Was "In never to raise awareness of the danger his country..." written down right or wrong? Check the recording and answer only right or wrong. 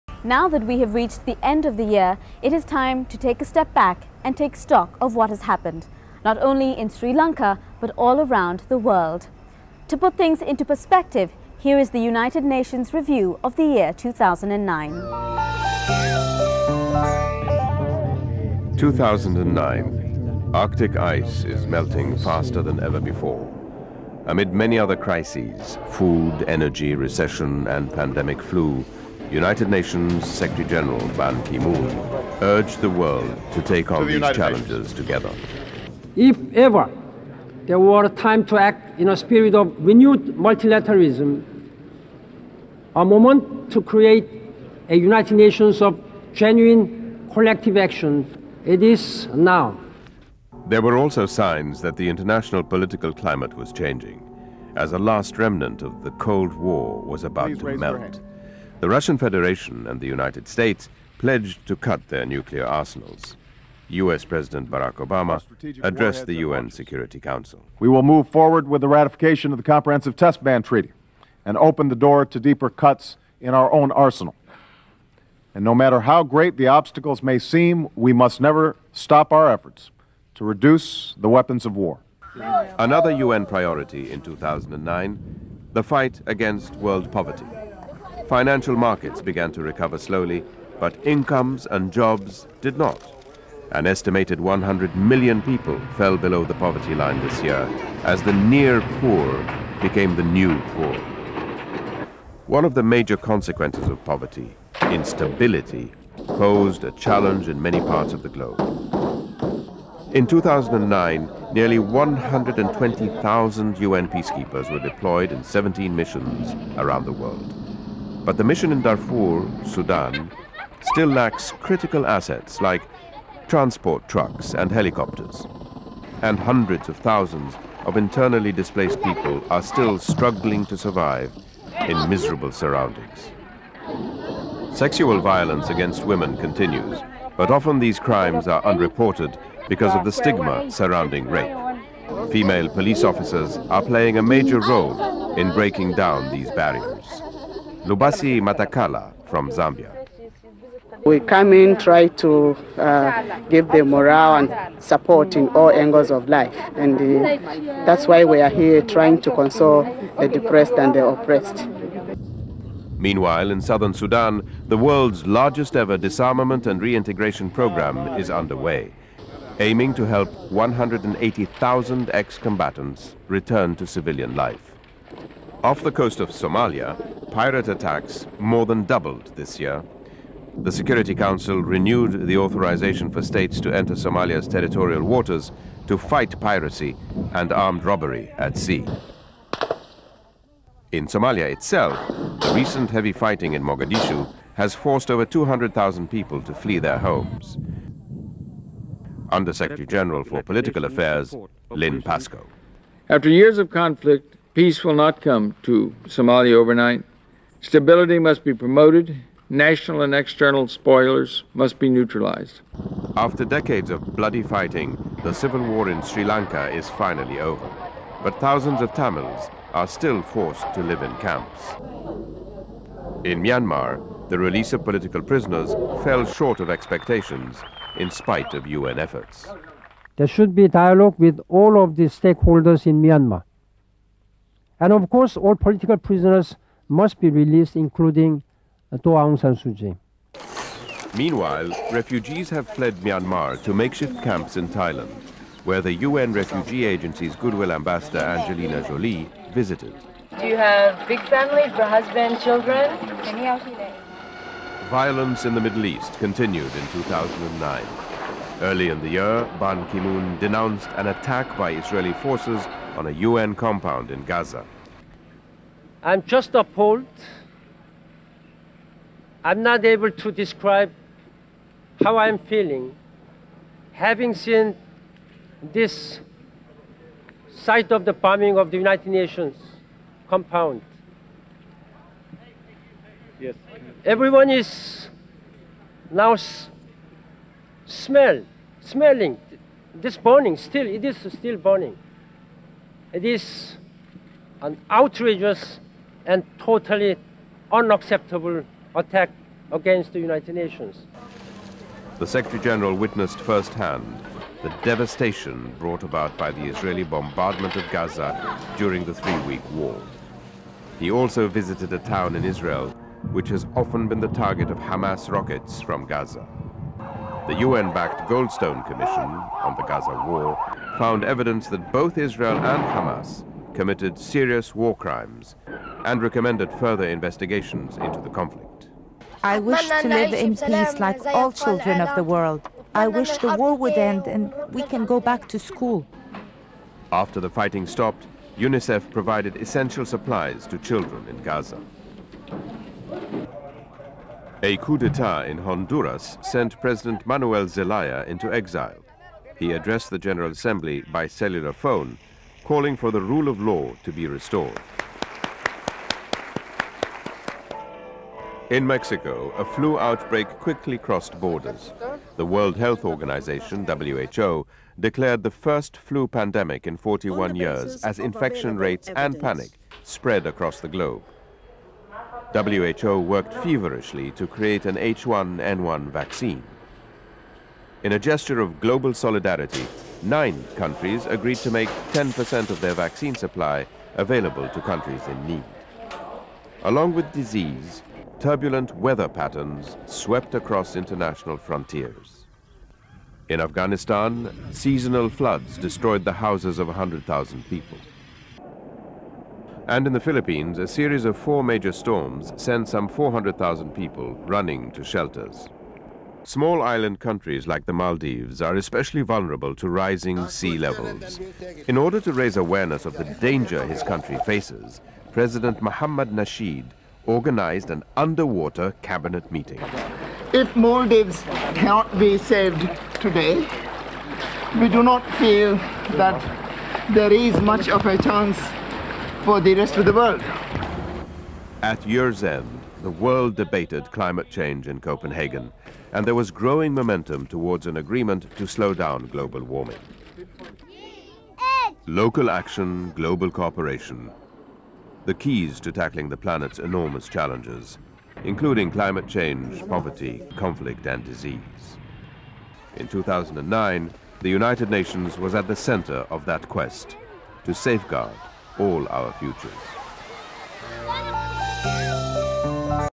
wrong.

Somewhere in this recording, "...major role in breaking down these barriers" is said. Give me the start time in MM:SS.
02:24.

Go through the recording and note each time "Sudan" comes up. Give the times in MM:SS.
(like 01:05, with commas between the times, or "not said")
01:59, 02:43.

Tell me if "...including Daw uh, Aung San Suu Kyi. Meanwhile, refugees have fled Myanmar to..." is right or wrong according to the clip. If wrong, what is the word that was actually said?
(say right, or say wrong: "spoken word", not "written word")
right.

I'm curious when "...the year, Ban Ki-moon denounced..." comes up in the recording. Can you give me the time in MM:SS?
04:19.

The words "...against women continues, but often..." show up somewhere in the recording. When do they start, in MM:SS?
02:15.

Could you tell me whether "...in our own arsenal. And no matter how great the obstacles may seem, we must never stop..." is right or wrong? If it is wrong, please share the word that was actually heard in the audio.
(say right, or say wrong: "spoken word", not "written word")
right.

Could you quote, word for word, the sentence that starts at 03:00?
The Security Council renewed the authorization for states to enter Somalia's territorial waters to fight piracy and armed robbery at sea.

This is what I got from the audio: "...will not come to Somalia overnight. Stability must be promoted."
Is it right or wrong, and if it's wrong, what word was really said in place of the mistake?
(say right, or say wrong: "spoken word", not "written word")
right.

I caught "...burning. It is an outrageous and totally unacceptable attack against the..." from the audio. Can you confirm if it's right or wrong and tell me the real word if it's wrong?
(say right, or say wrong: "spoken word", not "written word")
right.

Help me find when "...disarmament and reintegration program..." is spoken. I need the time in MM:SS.
02:45.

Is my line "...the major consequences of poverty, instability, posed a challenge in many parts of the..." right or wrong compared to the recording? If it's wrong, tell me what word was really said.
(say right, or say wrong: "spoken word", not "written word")
right.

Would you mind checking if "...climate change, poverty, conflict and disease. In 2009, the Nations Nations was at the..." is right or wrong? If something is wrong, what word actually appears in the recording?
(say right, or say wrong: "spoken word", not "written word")
wrong: "United", not "Nations".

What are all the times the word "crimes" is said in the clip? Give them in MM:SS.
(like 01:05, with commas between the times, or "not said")
02:17, 05:24.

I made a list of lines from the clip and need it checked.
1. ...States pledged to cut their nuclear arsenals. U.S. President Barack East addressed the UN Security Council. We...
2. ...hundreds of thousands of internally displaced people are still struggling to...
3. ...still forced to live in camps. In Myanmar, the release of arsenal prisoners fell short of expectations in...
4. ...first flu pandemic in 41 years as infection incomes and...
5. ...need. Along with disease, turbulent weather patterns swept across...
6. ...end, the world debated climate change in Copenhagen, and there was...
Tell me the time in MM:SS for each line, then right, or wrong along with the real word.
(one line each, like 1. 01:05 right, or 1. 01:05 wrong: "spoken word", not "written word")
1. 01:00 wrong: "Obama", not "East"
2. 02:06 right
3. 03:39 wrong: "political", not "arsenal"
4. 06:05 wrong: "rates", not "incomes"
5. 06:25 right
6. 07:12 right.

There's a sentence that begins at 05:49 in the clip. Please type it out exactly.
He addressed the General Assembly by cellular phone, calling for the rule of law to be restored.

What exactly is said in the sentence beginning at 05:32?
I wish the war would end and we can go back to school.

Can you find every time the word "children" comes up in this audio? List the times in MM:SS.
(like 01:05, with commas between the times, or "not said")
04:12, 05:31, 05:40.